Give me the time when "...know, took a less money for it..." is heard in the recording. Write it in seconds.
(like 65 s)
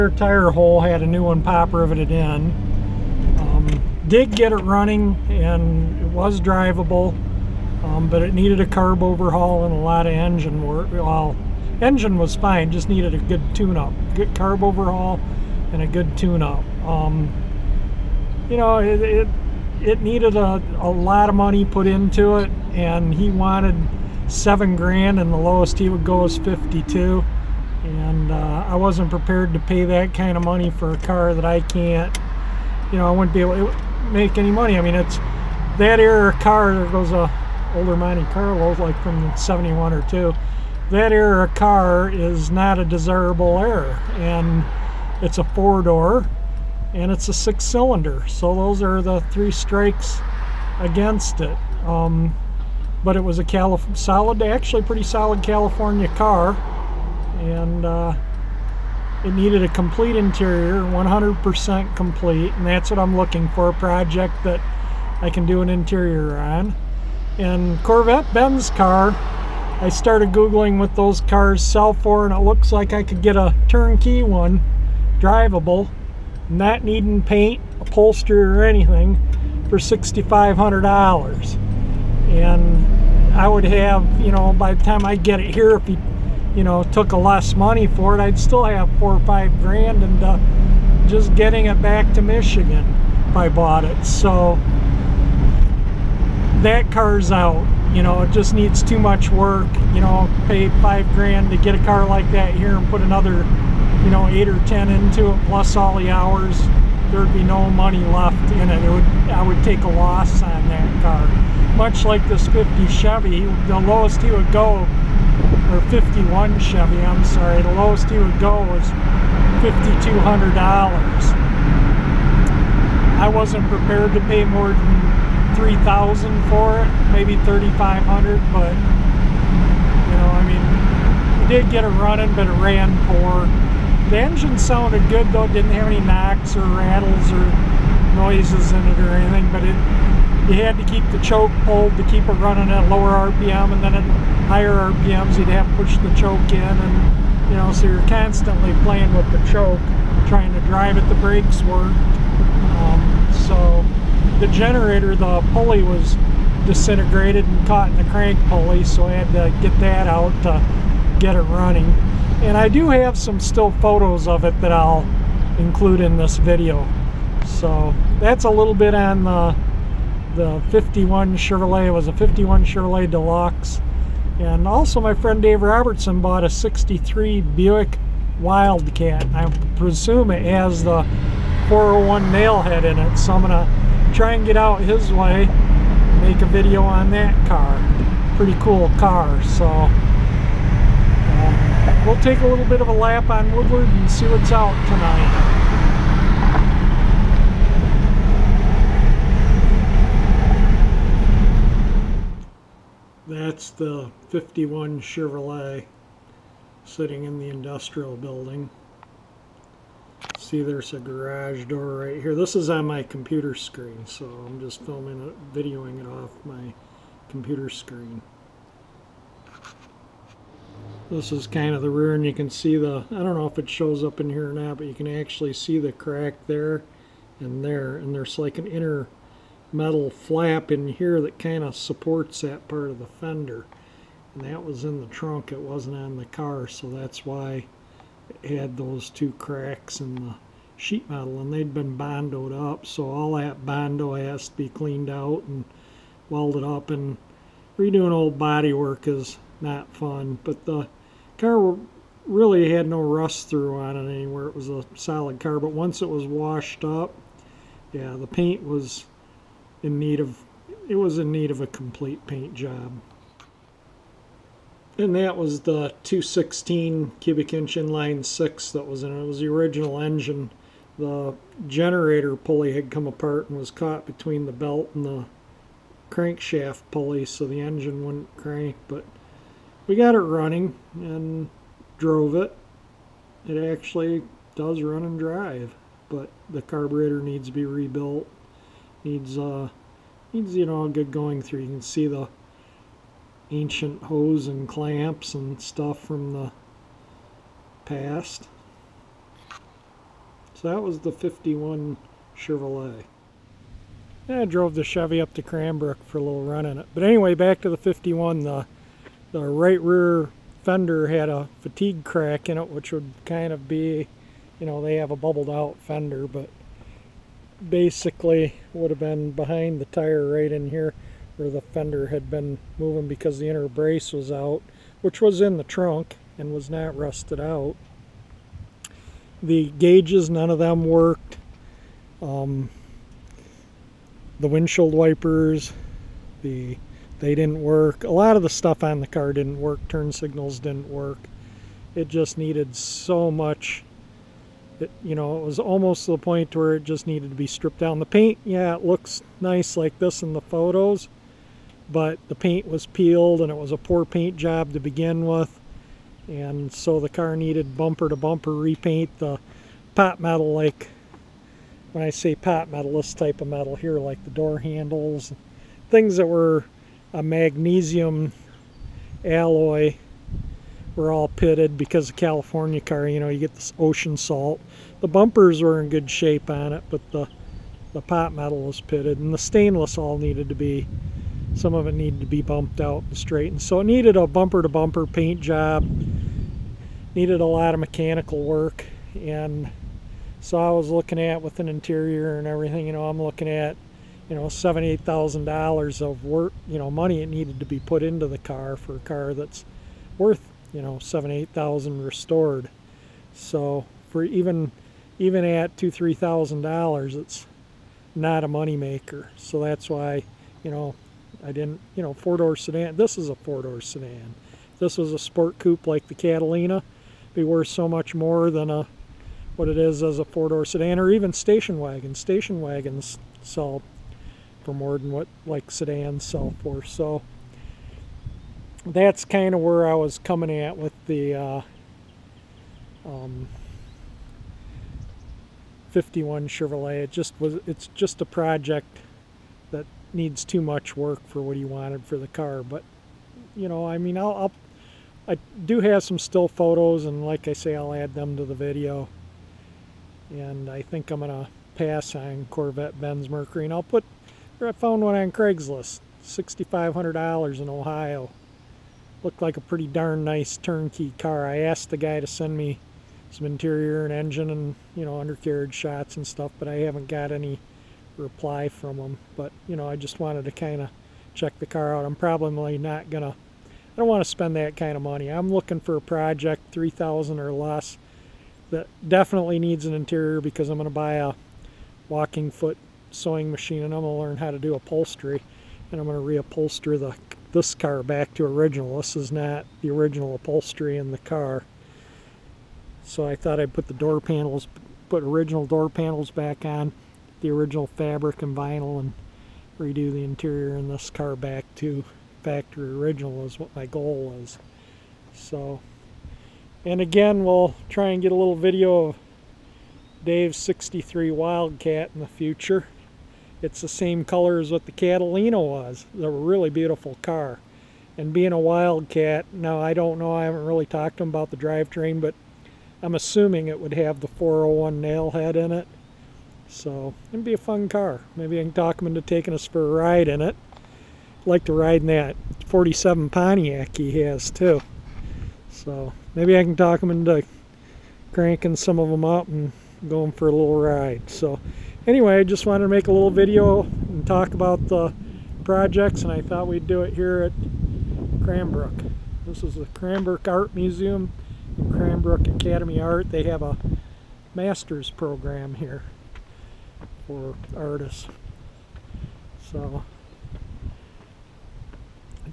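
86 s.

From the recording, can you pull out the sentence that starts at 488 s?
This is not the original upholstery in the car.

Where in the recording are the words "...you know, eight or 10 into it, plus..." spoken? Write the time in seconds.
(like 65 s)
104 s.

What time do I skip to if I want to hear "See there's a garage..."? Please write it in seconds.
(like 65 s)
210 s.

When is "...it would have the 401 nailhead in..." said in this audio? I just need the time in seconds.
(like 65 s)
523 s.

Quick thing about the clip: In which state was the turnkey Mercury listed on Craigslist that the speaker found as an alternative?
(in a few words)
Ohio.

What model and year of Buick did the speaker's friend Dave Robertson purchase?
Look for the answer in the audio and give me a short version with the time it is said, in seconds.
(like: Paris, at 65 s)
63 Buick Wildcat, at 176 s.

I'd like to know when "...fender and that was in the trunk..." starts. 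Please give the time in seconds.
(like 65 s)
233 s.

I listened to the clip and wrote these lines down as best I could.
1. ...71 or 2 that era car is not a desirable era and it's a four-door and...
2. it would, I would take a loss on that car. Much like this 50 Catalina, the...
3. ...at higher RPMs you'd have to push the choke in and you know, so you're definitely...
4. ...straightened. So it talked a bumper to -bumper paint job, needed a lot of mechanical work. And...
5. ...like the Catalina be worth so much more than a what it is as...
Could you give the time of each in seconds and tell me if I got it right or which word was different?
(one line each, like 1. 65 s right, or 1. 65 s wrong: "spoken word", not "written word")
1. 39 s right
2. 108 s wrong: "Chevy", not "Catalina"
3. 143 s wrong: "constantly", not "definitely"
4. 383 s wrong: "needed", not "talked"
5. 415 s right.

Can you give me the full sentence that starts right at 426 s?
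So that's kind of where I was coming at with the uh, um, 51 Chevrolet.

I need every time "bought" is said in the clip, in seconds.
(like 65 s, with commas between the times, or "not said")
93 s, 176 s.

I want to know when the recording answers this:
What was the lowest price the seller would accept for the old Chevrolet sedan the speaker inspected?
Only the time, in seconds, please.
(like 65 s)
119 s.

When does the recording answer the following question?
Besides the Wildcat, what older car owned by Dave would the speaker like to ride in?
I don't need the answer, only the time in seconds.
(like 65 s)
532 s.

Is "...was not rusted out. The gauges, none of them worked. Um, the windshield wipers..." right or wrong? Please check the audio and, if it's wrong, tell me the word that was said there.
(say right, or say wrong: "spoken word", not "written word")
right.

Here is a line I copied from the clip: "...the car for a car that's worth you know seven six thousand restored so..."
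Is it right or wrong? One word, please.
wrong.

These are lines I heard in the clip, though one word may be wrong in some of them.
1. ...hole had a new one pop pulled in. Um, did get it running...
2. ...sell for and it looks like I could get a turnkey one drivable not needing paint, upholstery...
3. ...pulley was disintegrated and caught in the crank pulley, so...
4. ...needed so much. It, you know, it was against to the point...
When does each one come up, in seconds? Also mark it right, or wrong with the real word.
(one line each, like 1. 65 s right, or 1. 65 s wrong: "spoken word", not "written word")
1. 0 s wrong: "riveted", not "pulled"
2. 71 s right
3. 155 s right
4. 342 s wrong: "almost", not "against".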